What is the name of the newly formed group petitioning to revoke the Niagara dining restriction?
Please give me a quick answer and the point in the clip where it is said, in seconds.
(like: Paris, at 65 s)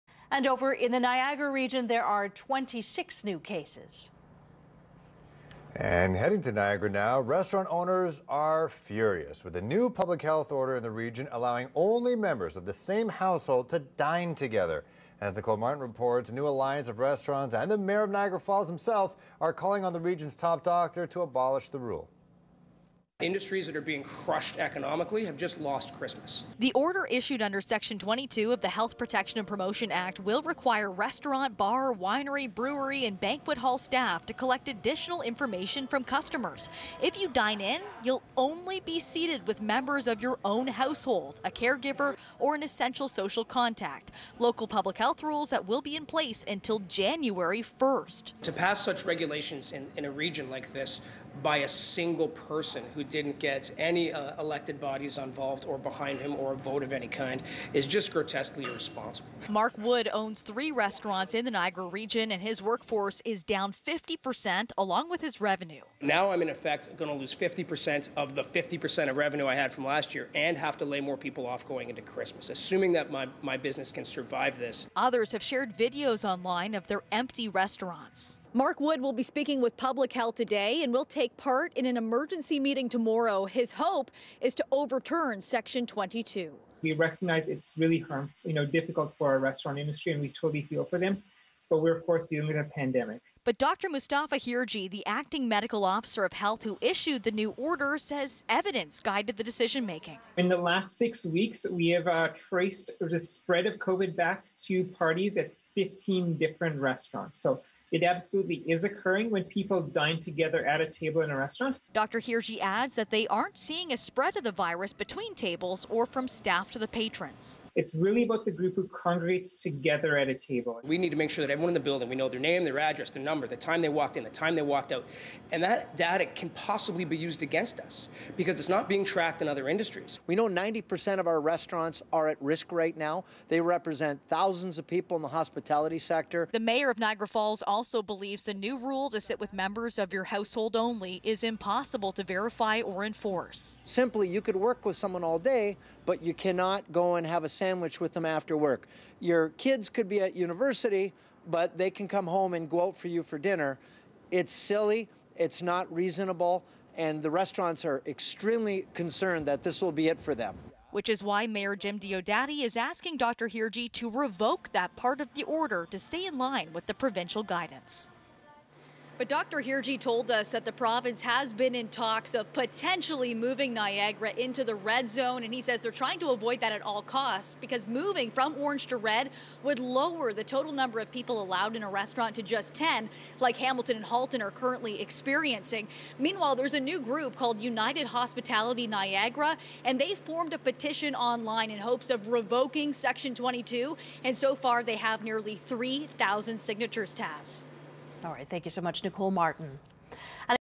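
United Hospitality Niagara, at 187 s.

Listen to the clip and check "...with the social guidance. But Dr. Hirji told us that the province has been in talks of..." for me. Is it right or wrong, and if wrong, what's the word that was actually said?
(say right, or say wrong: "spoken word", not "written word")
wrong: "provincial", not "social".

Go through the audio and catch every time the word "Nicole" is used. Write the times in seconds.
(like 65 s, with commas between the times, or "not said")
15 s, 199 s.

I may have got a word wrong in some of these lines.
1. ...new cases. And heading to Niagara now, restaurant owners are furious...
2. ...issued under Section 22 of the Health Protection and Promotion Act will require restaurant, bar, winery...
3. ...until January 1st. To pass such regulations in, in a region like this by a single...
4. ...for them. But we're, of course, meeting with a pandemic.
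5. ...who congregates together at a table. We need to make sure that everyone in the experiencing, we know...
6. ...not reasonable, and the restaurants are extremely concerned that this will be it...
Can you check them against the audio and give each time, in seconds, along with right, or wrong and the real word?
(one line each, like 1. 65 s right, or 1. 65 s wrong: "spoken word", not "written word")
1. 3 s right
2. 27 s right
3. 46 s right
4. 90 s wrong: "dealing", not "meeting"
5. 118 s wrong: "building", not "experiencing"
6. 155 s right.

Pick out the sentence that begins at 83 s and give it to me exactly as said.
His hope is to overturn Section 22.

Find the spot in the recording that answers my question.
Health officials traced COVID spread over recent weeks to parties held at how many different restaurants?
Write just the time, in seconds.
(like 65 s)
105 s.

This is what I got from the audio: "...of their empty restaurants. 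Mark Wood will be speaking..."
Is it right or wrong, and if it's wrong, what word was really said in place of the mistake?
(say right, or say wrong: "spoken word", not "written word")
right.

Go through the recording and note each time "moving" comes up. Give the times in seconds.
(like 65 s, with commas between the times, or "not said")
173 s, 177 s.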